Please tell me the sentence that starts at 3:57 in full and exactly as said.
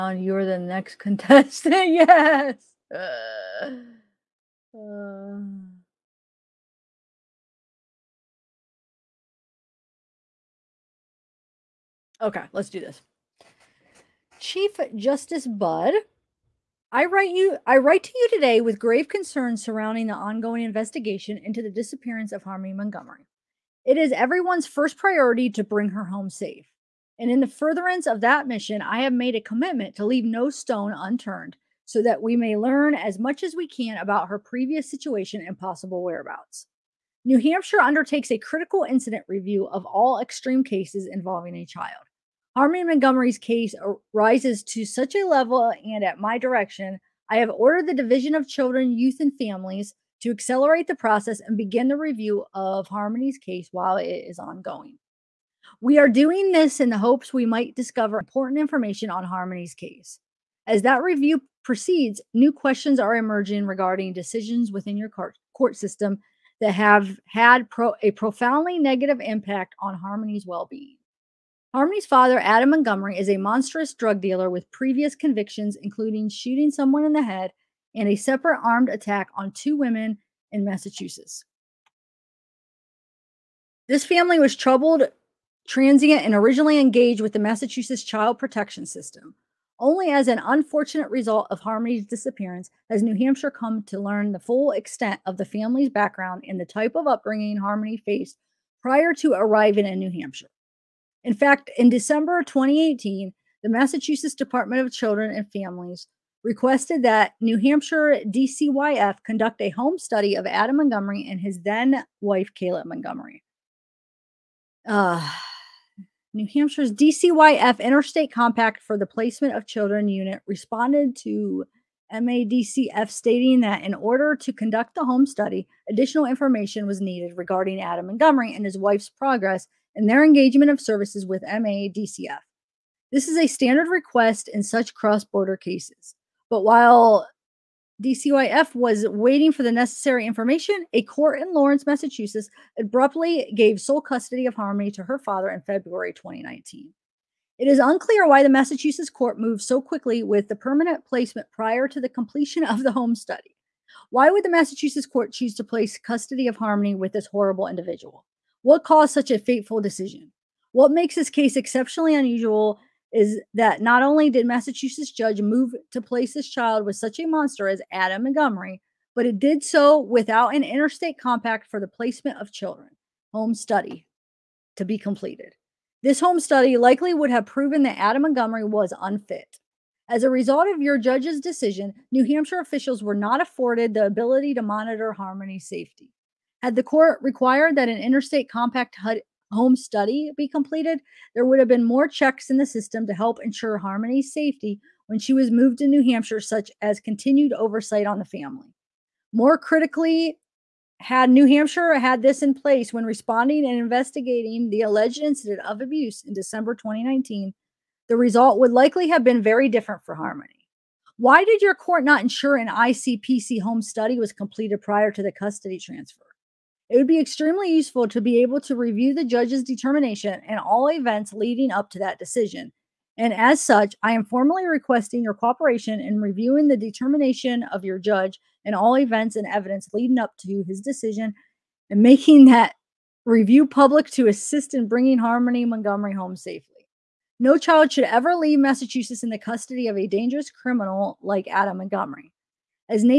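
No child should ever leave Massachusetts in the custody of a dangerous criminal like Adam Montgomery.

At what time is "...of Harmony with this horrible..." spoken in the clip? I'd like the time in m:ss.
2:36.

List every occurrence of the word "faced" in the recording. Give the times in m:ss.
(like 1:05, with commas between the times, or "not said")
1:37.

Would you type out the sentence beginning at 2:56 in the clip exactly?
This home study likely would have proven that Adam Montgomery was unfit.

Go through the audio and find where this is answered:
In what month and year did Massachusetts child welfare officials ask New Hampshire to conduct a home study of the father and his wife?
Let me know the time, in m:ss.
1:41.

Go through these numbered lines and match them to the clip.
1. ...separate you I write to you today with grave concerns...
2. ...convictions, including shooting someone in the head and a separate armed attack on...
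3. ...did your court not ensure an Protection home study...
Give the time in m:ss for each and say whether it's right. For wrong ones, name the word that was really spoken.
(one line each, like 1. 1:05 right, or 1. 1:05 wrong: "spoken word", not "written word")
1. 0:17 wrong: "write", not "separate"
2. 1:15 right
3. 3:31 wrong: "ICPC", not "Protection".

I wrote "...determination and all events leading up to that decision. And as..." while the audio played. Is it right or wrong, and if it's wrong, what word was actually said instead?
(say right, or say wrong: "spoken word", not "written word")
right.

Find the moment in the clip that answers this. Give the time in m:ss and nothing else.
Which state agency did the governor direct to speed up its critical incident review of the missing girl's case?
0:47.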